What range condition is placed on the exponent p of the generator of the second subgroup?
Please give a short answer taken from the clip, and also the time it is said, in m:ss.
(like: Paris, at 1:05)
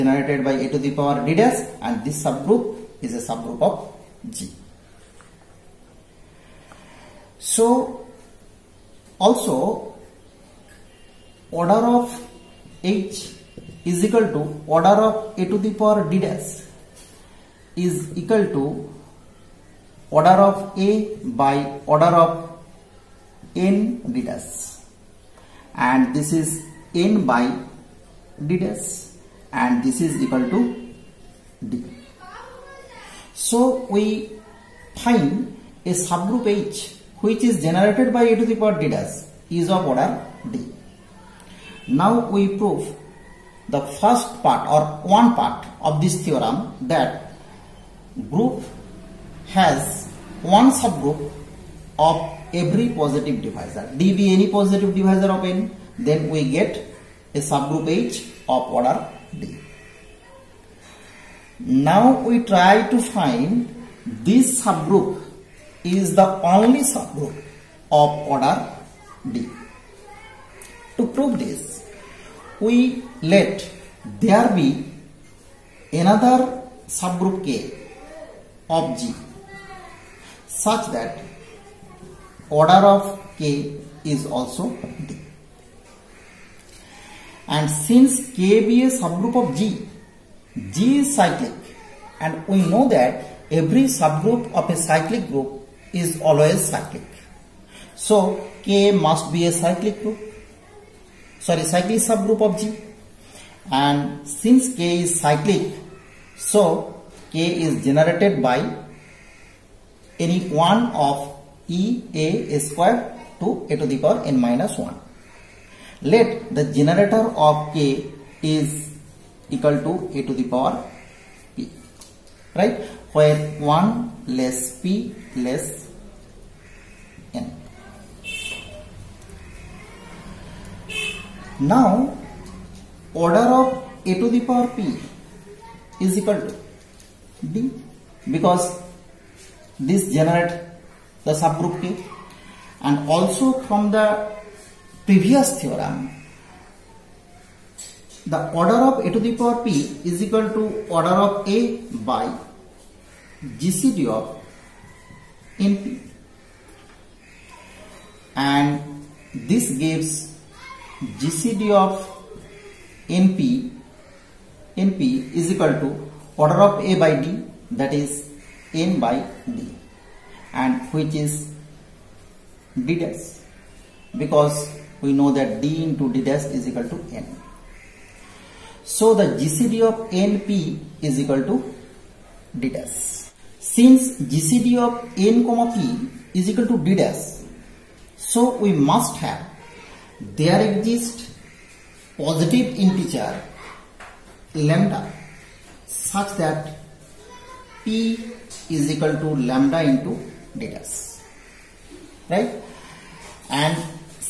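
1 < p < n, at 2:03.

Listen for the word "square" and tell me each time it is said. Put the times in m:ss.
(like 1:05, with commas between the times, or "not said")
1:52.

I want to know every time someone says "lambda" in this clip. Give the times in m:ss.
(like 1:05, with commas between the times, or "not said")
3:14, 3:19.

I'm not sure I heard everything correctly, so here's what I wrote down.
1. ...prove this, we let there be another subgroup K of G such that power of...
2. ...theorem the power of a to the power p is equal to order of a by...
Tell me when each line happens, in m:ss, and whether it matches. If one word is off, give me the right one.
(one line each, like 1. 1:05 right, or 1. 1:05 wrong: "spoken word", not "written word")
1. 1:11 wrong: "order", not "power"
2. 2:25 wrong: "order", not "power".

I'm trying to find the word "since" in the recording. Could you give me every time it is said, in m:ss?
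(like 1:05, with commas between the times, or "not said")
1:27, 1:44, 3:03.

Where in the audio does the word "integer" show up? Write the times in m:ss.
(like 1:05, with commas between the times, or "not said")
3:12.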